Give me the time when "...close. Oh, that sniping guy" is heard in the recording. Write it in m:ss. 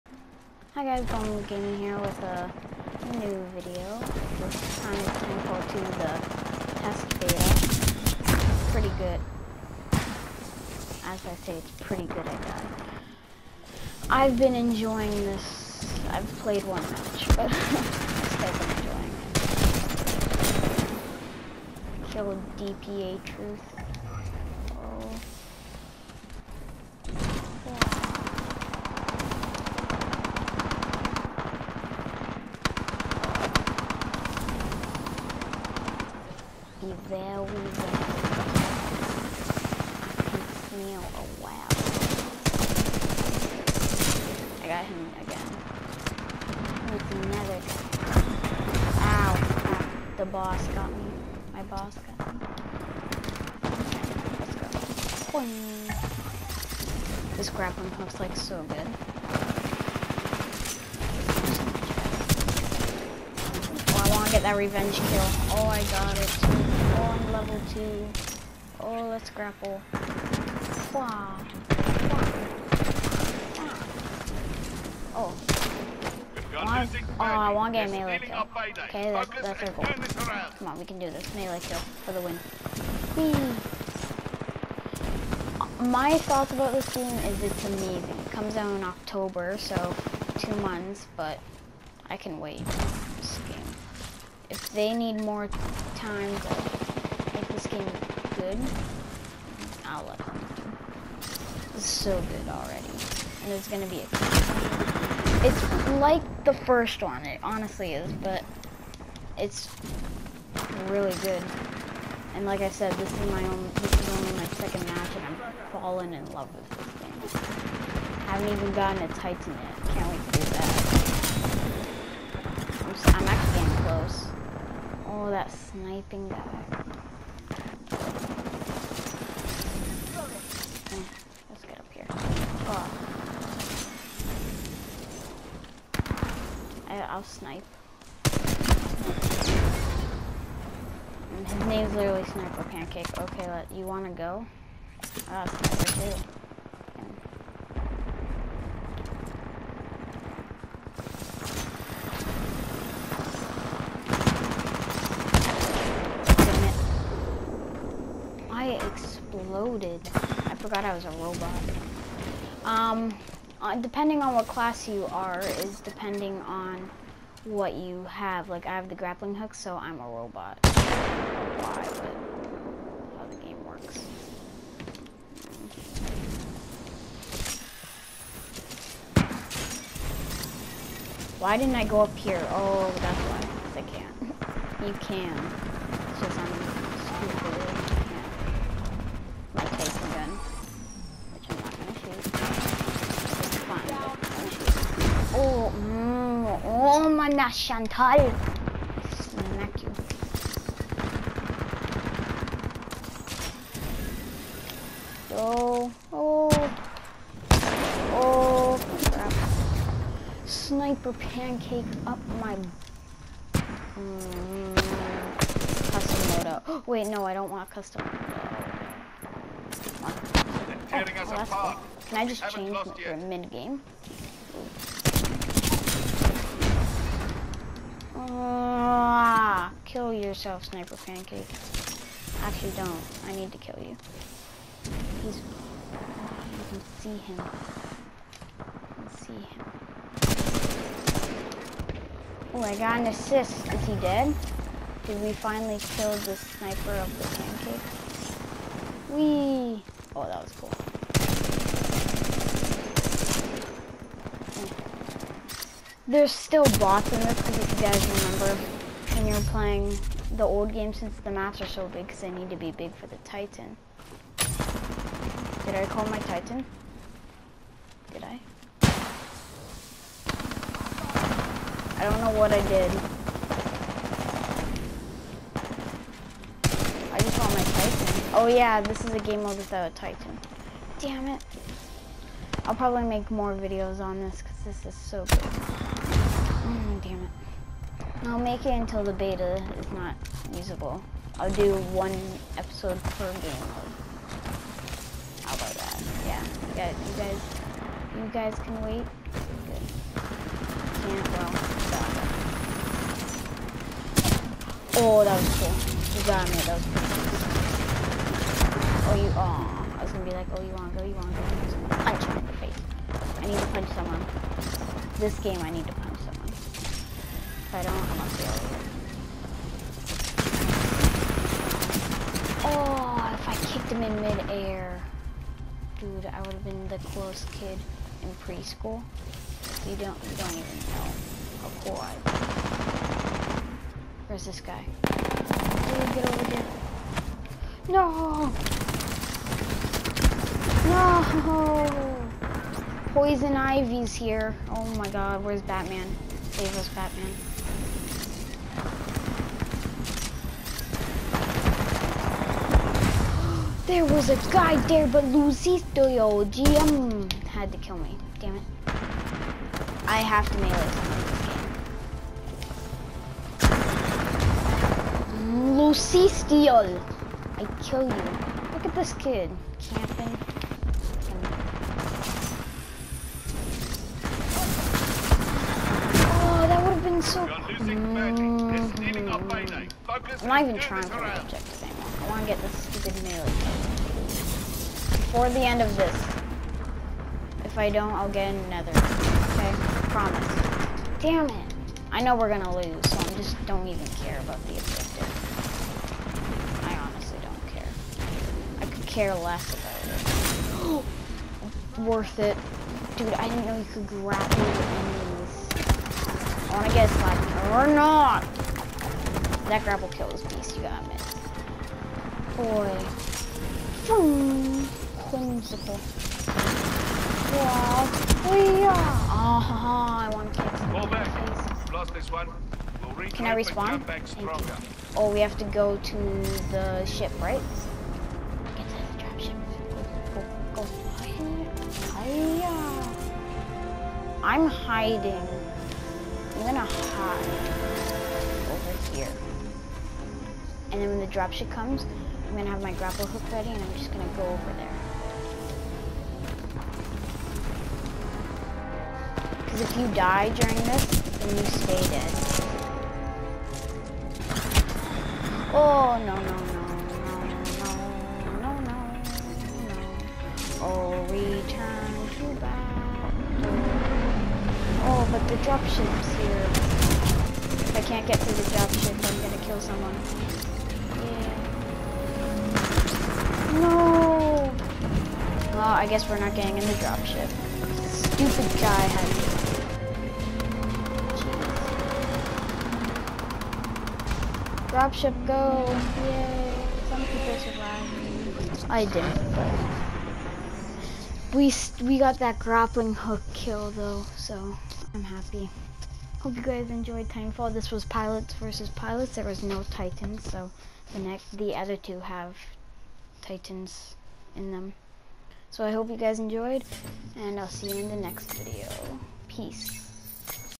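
2:03.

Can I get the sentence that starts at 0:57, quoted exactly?
This grappling hook's like so good.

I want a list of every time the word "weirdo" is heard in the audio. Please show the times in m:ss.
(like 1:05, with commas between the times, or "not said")
not said.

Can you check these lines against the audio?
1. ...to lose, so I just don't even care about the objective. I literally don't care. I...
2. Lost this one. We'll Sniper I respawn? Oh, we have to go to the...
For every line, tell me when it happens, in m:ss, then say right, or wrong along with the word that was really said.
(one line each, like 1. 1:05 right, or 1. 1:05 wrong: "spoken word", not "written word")
1. 6:32 wrong: "honestly", not "literally"
2. 7:01 wrong: "Can", not "Sniper".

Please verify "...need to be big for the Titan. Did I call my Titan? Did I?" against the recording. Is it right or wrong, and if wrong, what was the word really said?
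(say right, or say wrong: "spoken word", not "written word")
right.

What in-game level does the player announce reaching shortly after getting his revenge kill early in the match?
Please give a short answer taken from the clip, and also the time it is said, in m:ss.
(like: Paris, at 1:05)
Level 2, at 1:07.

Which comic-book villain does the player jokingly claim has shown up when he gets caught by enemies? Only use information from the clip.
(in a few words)
Poison Ivy.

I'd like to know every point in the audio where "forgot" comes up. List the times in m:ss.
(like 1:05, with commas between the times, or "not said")
2:40.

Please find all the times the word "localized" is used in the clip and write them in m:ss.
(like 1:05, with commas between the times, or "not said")
not said.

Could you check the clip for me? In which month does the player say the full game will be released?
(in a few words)
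October.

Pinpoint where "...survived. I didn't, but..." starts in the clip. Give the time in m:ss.
8:07.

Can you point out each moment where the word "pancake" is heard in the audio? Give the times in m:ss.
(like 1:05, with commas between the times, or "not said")
2:22, 3:31, 3:50, 4:07.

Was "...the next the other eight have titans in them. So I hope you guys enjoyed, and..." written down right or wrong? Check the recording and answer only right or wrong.
wrong.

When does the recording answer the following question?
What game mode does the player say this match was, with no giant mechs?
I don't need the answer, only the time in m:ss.
8:18.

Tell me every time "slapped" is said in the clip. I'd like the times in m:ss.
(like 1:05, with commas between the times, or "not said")
6:47.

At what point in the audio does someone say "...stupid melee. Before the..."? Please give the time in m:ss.
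6:22.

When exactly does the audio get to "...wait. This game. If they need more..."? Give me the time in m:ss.
1:32.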